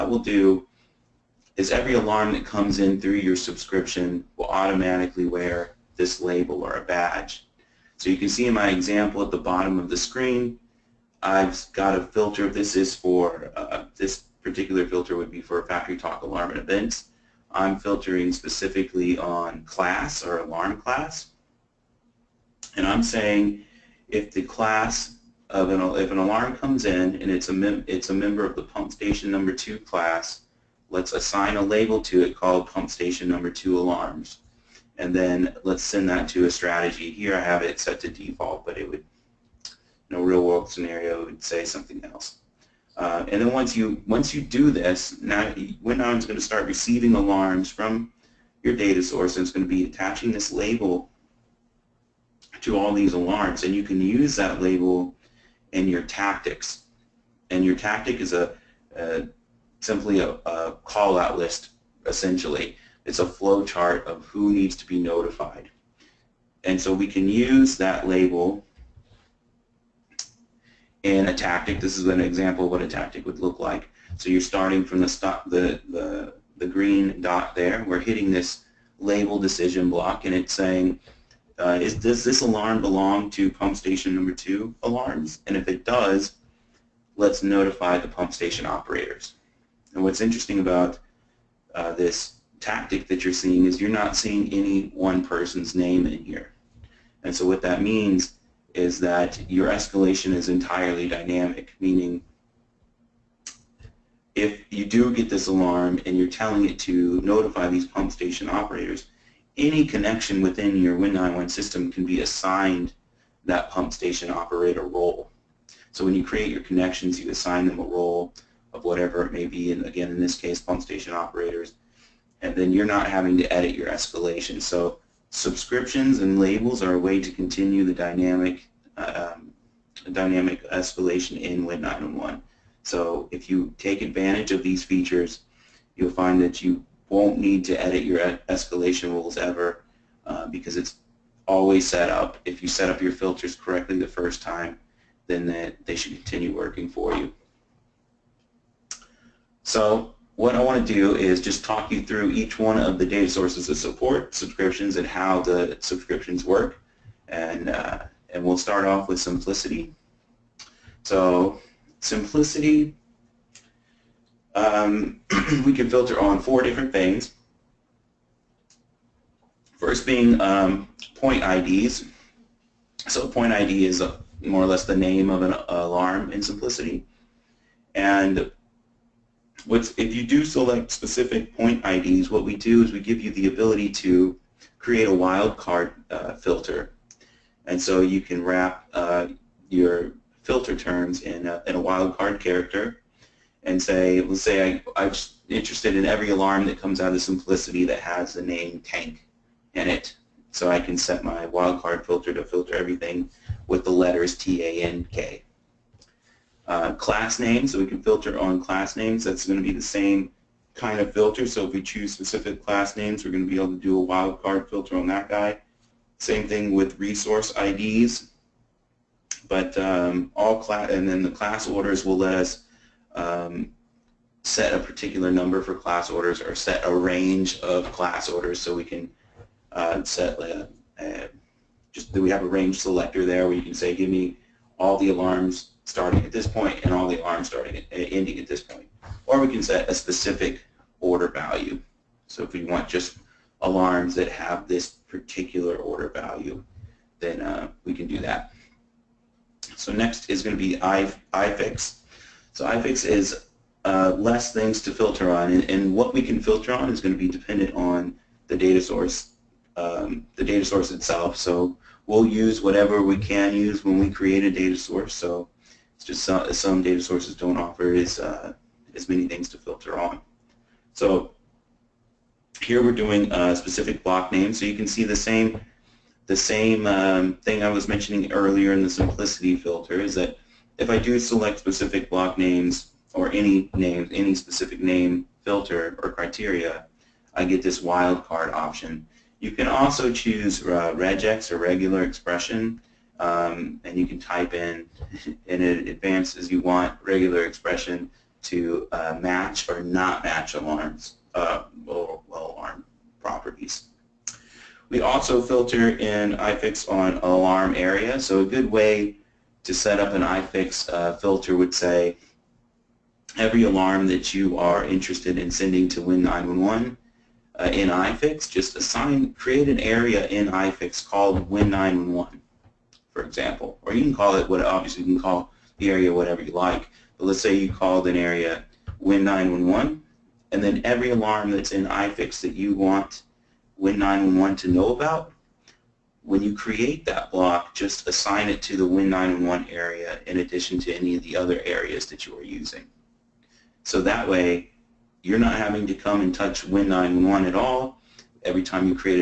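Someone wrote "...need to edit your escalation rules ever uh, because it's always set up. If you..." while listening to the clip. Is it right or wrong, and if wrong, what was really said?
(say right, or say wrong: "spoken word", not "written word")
right.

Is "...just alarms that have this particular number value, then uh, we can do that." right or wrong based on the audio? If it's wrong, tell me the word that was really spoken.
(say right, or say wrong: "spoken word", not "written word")
wrong: "order", not "number".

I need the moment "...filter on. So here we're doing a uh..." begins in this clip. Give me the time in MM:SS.
04:29.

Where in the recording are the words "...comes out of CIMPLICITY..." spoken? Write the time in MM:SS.
03:16.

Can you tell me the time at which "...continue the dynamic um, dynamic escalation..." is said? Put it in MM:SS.
02:07.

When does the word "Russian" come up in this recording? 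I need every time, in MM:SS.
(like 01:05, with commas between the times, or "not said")
not said.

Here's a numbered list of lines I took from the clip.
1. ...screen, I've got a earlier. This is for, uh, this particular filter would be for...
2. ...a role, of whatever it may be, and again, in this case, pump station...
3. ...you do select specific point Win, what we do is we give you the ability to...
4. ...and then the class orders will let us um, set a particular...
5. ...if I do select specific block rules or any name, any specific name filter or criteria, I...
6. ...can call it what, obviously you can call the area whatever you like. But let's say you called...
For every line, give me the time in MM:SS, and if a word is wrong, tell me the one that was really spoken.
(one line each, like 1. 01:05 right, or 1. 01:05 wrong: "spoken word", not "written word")
1. 00:09 wrong: "filter", not "earlier"
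2. 01:57 right
3. 03:00 wrong: "IDs", not "Win"
4. 03:40 right
5. 04:40 wrong: "names", not "rules"
6. 05:24 right.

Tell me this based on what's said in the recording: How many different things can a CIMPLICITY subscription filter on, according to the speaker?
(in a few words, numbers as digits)
4.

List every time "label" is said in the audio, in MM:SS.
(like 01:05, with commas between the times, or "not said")
00:06, 00:31, 00:50, 00:54, 01:08, 01:18, 02:06.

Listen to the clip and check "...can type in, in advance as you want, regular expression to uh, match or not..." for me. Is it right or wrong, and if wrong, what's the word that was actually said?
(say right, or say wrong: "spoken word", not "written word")
right.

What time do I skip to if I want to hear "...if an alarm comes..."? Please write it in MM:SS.
00:26.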